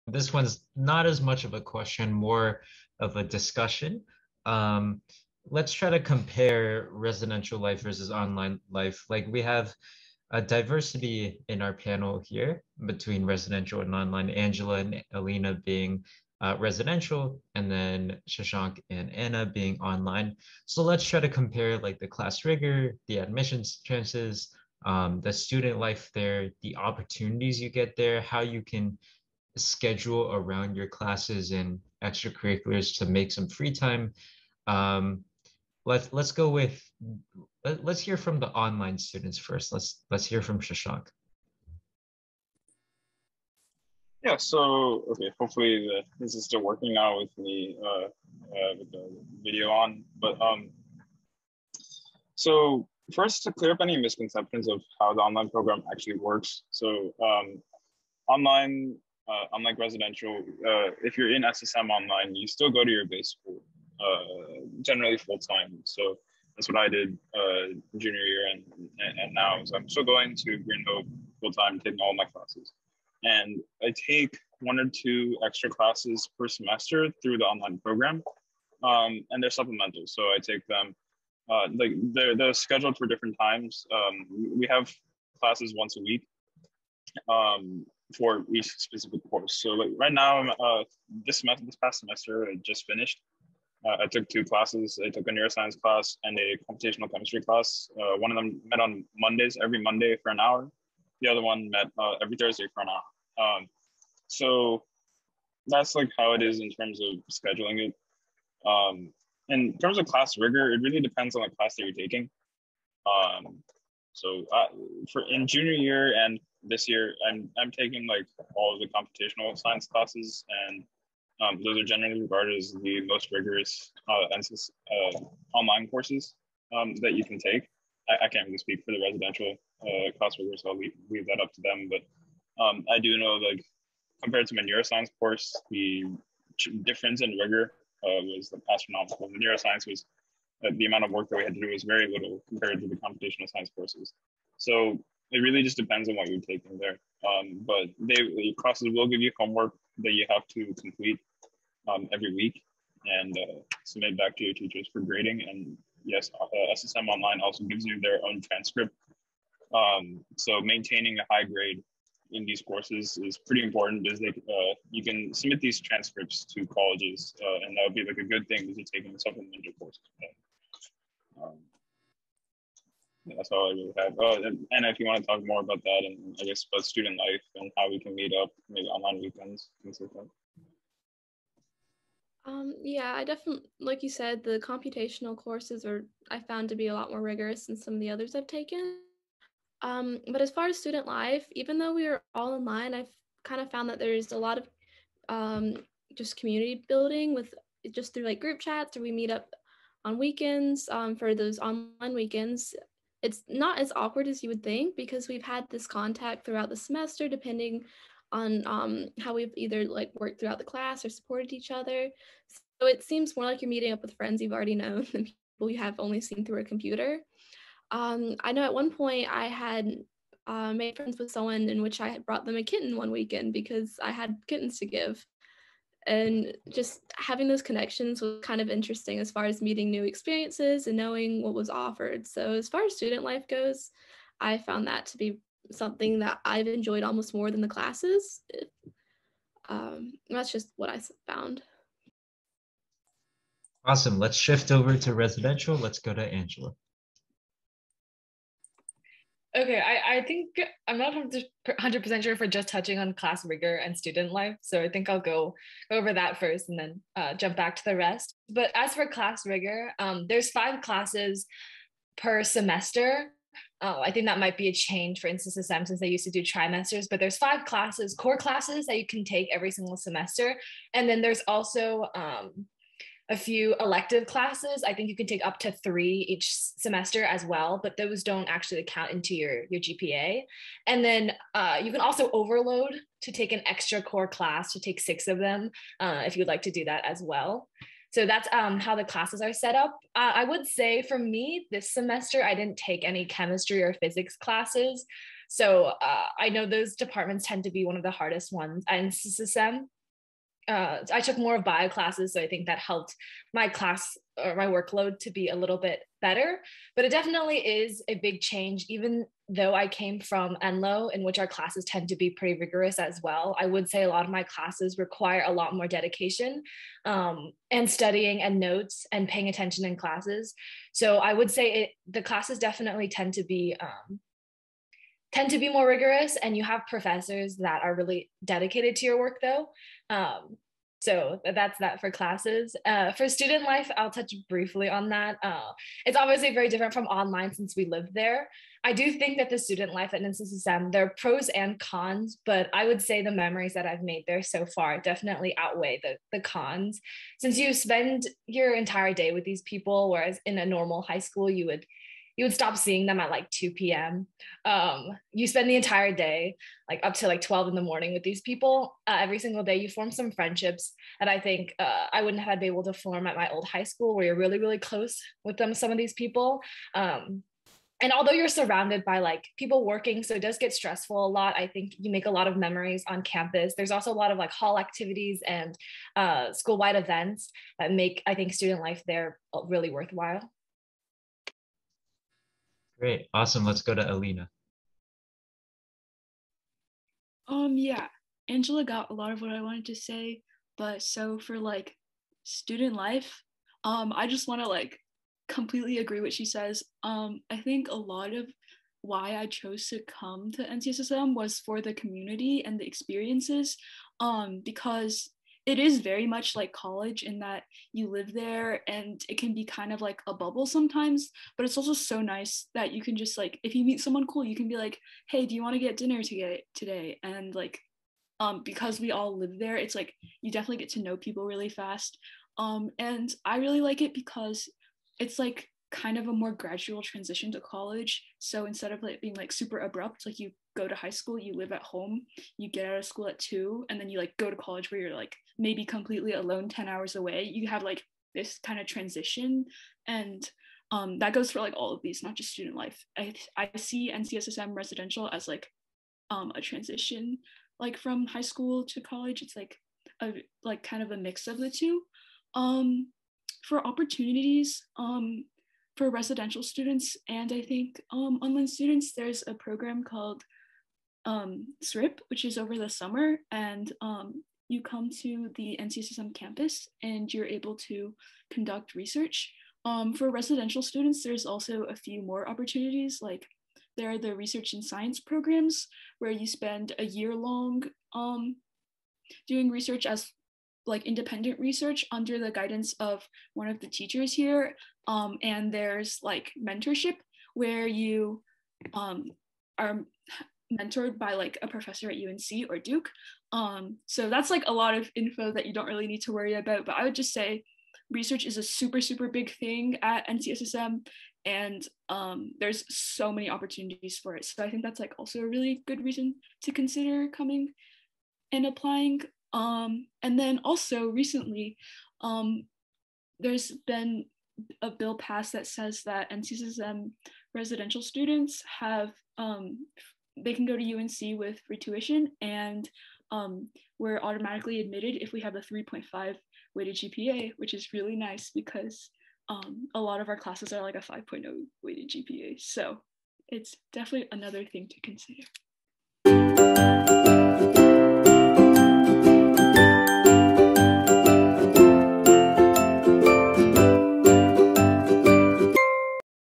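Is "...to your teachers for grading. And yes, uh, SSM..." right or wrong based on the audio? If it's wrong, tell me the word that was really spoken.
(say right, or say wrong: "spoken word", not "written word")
right.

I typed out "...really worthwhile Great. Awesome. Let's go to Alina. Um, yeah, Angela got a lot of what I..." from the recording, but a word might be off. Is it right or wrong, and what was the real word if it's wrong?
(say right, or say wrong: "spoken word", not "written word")
right.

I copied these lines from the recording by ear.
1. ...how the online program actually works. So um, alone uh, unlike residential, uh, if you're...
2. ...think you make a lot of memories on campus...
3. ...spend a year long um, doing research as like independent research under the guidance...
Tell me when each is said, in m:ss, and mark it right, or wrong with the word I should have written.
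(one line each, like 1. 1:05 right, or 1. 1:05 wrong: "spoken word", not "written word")
1. 0:54 wrong: "online", not "alone"
2. 6:11 right
3. 7:56 right.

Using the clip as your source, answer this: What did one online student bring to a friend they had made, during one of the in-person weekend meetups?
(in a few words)
A kitten.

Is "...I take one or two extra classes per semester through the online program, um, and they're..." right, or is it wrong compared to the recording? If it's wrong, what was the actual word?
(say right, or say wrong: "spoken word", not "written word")
right.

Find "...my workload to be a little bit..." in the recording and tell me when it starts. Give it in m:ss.
5:04.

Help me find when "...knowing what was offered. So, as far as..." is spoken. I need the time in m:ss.
3:50.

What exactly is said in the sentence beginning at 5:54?
Um, you spend the entire day, like up to like 12 in the morning with these people.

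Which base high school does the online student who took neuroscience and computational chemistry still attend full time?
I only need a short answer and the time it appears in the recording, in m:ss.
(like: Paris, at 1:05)
Green Hope, at 1:10.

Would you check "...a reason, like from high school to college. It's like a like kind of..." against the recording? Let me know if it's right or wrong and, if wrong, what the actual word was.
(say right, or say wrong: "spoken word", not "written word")
wrong: "transition", not "reason".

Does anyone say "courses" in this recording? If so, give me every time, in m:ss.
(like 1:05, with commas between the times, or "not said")
1:29, 2:05, 2:15, 2:23, 2:42, 2:49, 3:05.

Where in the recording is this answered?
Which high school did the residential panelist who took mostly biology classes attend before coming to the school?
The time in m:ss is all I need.
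5:10.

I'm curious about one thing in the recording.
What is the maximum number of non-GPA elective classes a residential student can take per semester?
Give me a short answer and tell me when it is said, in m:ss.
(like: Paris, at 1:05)
3, at 4:35.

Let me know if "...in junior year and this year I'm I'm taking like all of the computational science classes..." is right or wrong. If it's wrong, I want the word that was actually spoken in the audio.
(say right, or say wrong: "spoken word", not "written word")
right.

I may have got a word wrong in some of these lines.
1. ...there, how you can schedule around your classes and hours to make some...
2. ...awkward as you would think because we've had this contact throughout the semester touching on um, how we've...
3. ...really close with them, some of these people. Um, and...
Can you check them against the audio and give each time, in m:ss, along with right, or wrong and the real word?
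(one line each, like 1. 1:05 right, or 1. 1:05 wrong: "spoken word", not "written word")
1. 0:27 wrong: "extracurriculars", not "hours"
2. 3:23 wrong: "depending", not "touching"
3. 6:04 right.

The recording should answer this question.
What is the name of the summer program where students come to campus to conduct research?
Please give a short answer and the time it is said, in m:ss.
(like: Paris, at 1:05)
SRIP, at 7:41.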